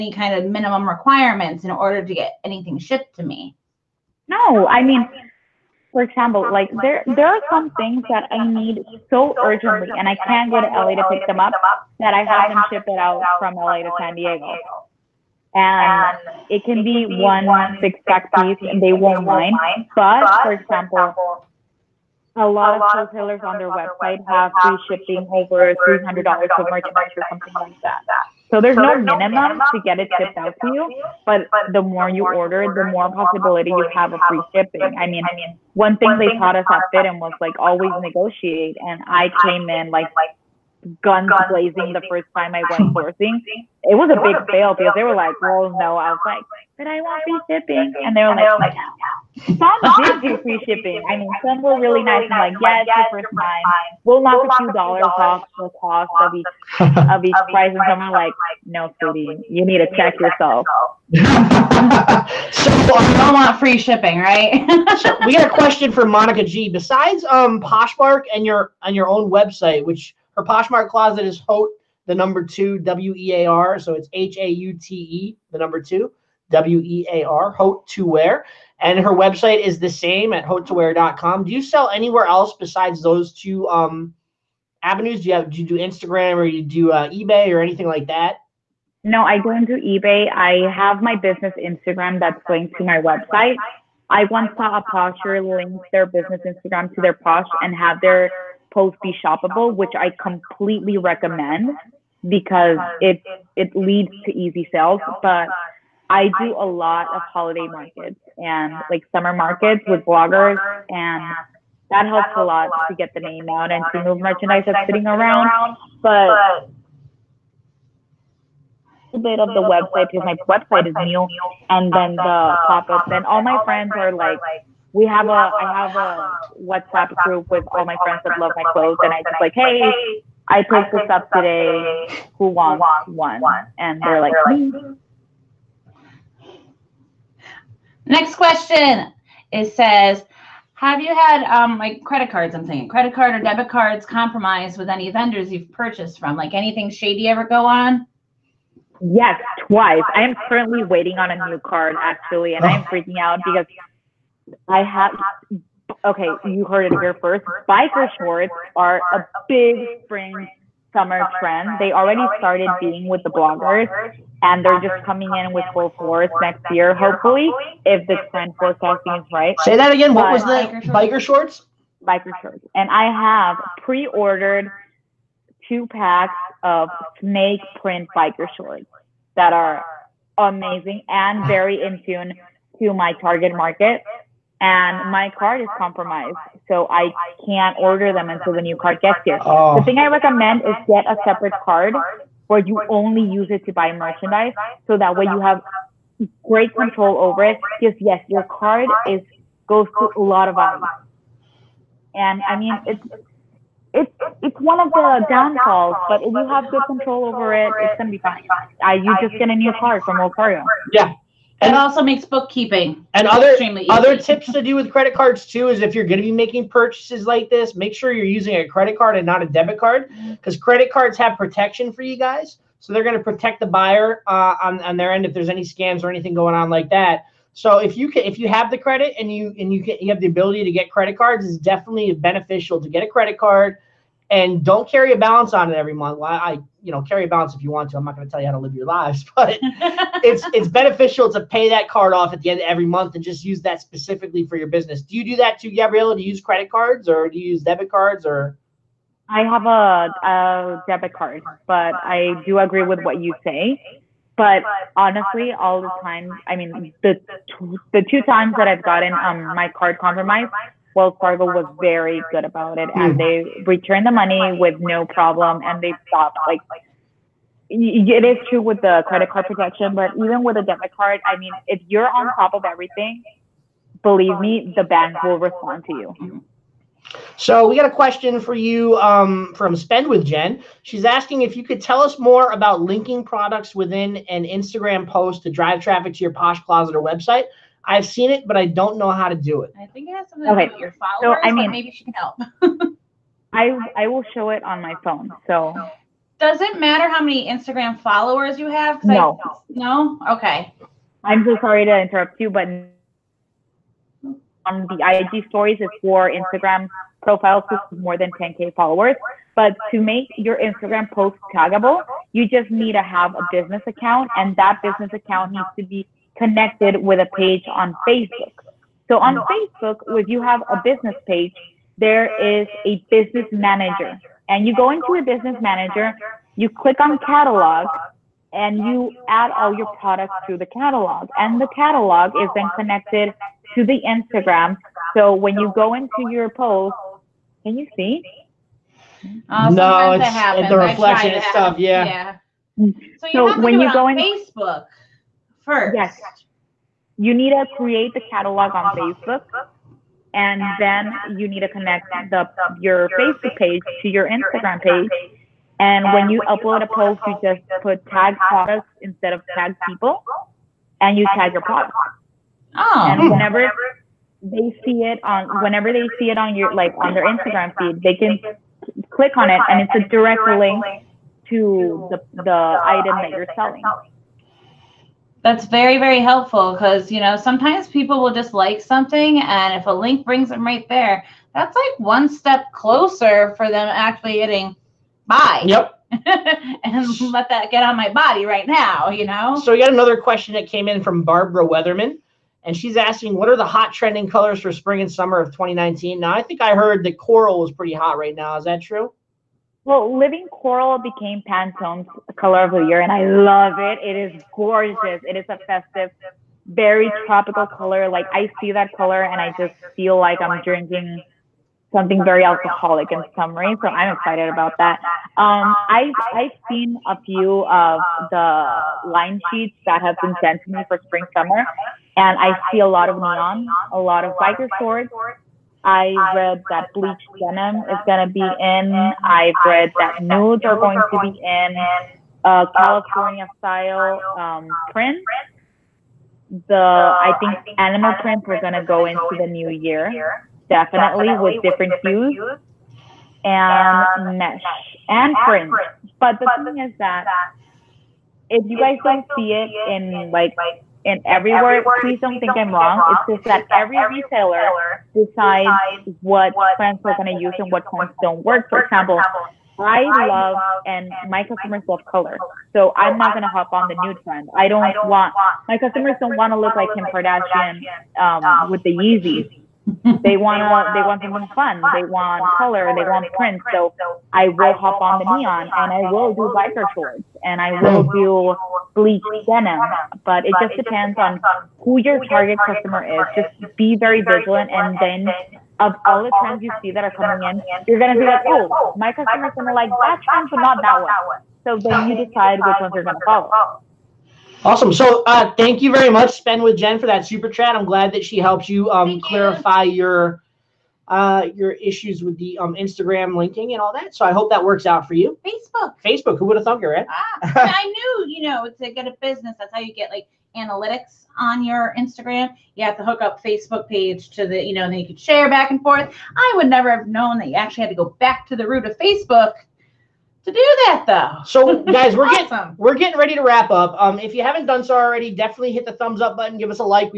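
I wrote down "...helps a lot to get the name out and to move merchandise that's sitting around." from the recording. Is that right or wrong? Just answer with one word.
right.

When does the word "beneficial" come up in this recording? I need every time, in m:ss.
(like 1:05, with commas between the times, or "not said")
3:52, 4:00.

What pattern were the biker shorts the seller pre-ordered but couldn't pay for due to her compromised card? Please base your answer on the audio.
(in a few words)
Snake print.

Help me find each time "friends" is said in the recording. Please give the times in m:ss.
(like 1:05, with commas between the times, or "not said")
2:03, 2:08.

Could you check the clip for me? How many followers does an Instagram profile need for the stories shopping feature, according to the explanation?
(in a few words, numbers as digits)
10k.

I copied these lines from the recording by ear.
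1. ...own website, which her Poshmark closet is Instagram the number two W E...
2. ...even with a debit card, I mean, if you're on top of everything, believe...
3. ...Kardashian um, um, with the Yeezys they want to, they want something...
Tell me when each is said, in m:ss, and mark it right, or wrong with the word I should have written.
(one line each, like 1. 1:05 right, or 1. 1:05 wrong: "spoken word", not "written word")
1. 1:09 wrong: "Haute", not "Instagram"
2. 4:30 right
3. 7:47 right.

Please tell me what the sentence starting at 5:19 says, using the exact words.
So on Facebook, if you have a business page, there is a business manager.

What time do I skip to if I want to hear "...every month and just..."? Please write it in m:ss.
4:02.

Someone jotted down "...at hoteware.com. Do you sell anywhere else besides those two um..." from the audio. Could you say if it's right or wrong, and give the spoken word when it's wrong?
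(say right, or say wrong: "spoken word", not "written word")
right.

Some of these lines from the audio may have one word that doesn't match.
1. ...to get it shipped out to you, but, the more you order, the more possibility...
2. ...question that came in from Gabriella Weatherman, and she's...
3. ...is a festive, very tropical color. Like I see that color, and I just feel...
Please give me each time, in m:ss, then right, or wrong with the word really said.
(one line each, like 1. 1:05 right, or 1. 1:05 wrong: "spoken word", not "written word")
1. 0:29 right
2. 6:30 wrong: "Barbara", not "Gabriella"
3. 6:45 right.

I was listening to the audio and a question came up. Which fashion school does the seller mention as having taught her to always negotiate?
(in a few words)
FIDM.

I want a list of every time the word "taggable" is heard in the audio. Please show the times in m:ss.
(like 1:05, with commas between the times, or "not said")
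5:11.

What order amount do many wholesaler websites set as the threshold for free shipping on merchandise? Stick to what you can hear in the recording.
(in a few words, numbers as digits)
$300.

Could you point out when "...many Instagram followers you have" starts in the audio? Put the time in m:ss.
4:57.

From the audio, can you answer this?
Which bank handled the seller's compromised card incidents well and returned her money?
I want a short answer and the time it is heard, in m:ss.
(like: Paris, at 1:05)
Wells Fargo, at 4:21.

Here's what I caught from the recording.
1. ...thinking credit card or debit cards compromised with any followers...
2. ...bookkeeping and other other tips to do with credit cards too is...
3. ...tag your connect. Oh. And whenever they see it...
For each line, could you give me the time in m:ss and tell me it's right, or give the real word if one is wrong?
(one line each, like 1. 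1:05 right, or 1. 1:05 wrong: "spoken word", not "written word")
1. 2:22 wrong: "vendors", not "followers"
2. 3:32 right
3. 6:01 wrong: "product", not "connect".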